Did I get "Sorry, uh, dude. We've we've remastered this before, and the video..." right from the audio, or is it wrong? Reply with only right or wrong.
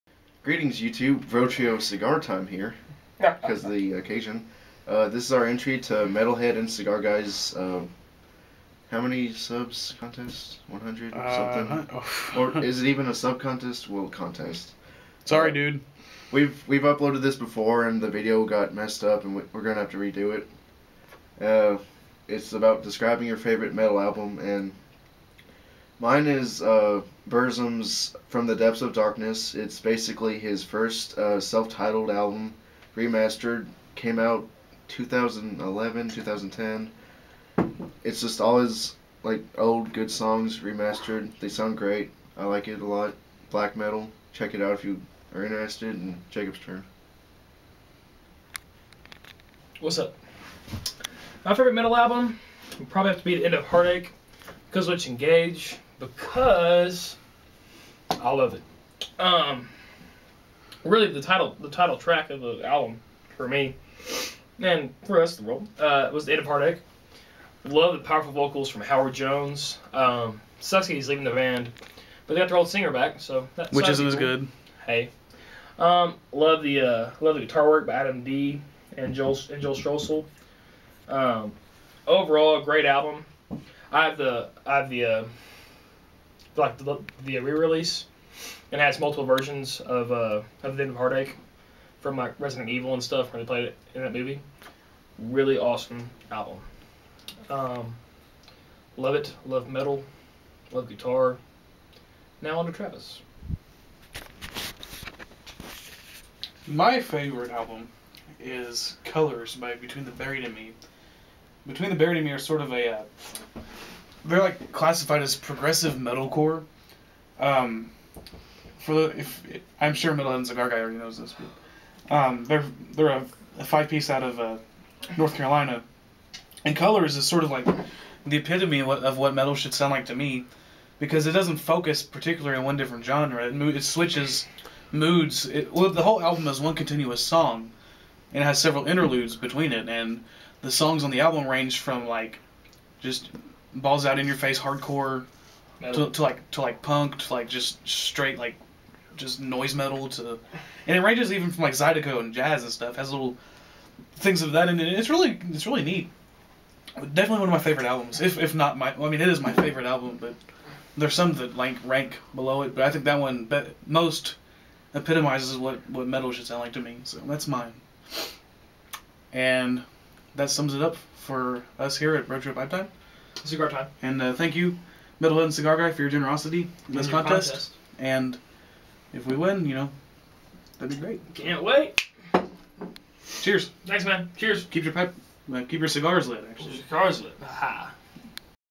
wrong.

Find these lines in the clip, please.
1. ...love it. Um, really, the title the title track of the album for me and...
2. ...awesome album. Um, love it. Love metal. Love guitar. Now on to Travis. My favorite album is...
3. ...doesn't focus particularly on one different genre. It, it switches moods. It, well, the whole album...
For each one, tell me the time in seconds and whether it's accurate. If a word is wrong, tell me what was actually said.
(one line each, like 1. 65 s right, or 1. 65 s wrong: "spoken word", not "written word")
1. 58 s right
2. 95 s right
3. 131 s right.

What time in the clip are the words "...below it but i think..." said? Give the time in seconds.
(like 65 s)
162 s.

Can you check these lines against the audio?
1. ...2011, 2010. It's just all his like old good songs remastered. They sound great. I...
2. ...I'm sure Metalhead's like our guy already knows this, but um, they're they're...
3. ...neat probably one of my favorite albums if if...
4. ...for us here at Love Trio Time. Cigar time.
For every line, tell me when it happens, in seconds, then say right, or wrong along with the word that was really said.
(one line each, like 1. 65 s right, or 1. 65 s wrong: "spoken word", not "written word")
1. 34 s right
2. 119 s right
3. 155 s wrong: "definitely", not "probably"
4. 171 s wrong: "Bro", not "Love".